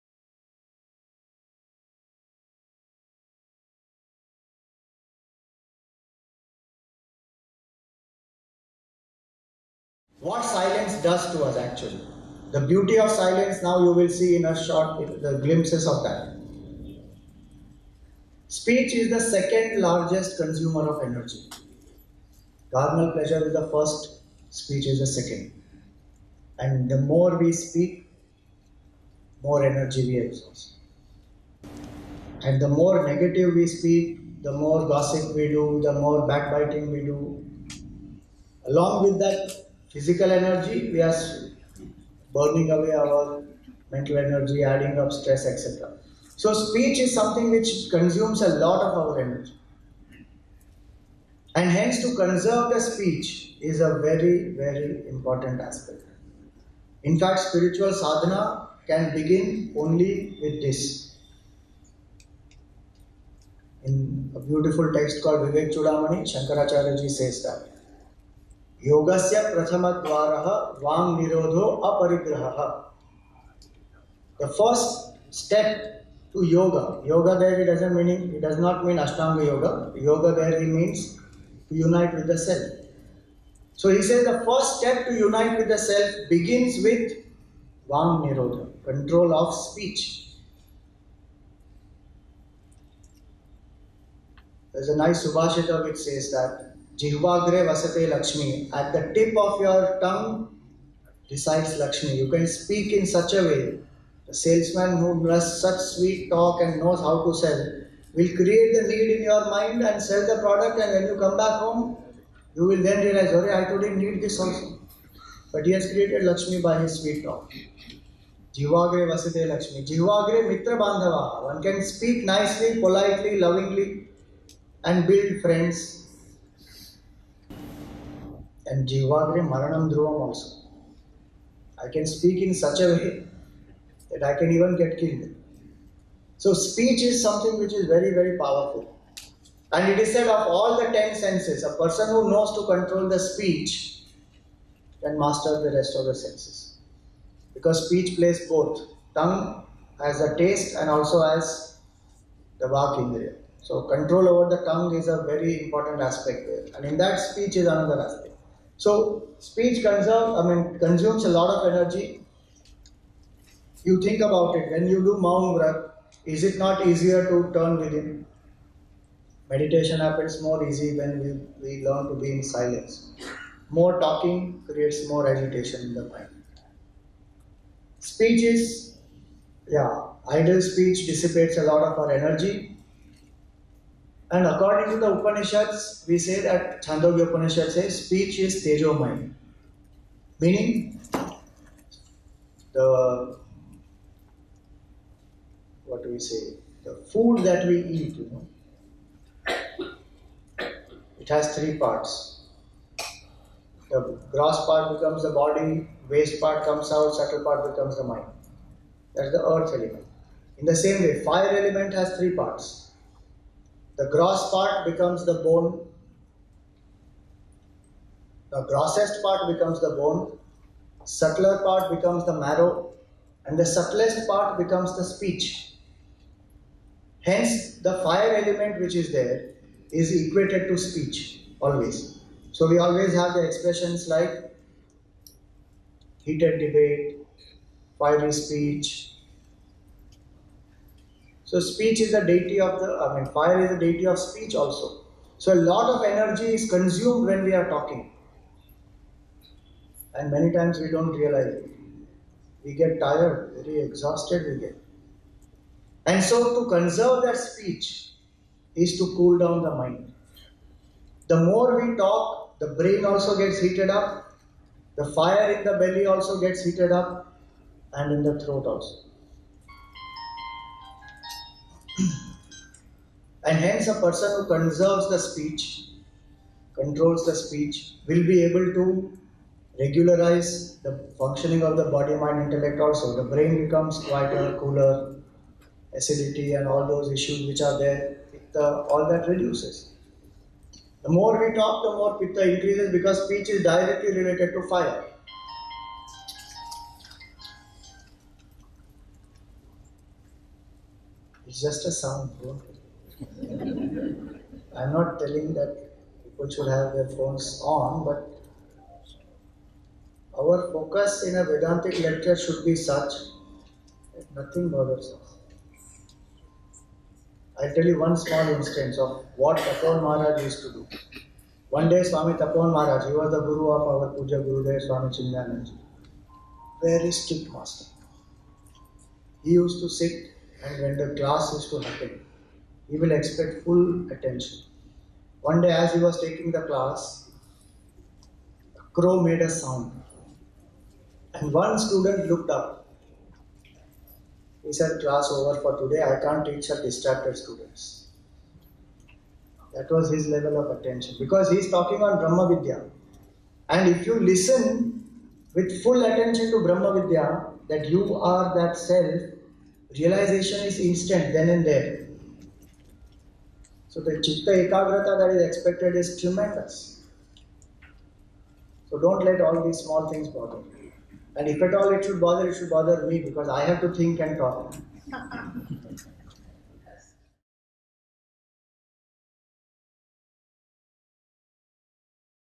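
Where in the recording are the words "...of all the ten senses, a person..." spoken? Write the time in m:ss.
2:20.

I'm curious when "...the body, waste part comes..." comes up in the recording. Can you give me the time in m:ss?
3:25.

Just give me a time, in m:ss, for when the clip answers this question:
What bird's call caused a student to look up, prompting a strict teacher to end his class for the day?
5:38.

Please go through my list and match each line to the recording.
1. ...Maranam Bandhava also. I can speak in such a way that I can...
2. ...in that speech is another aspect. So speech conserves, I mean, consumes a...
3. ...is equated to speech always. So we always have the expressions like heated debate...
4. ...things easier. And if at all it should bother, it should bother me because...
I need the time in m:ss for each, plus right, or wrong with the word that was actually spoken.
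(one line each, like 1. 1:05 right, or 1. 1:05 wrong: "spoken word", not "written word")
1. 2:09 wrong: "Dhruvam", not "Bandhava"
2. 2:36 right
3. 3:49 right
4. 6:10 wrong: "bother", not "easier".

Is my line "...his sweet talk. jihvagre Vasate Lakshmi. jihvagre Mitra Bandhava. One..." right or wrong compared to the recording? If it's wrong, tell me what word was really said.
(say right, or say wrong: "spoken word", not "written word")
right.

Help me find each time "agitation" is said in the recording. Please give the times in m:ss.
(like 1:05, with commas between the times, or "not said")
2:55.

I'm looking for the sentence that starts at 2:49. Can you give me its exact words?
Meditation happens more easy when we, we learn to be in silence.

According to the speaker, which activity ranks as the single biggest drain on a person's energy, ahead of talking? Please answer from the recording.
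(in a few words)
Carnal pleasure.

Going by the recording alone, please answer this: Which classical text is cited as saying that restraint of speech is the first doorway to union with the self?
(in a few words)
Vivek Chudamani.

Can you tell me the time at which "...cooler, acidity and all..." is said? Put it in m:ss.
4:44.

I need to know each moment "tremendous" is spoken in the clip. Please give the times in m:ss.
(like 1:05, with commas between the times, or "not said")
6:06.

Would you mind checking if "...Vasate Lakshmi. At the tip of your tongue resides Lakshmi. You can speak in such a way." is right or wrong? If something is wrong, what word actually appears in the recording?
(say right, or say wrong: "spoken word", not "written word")
right.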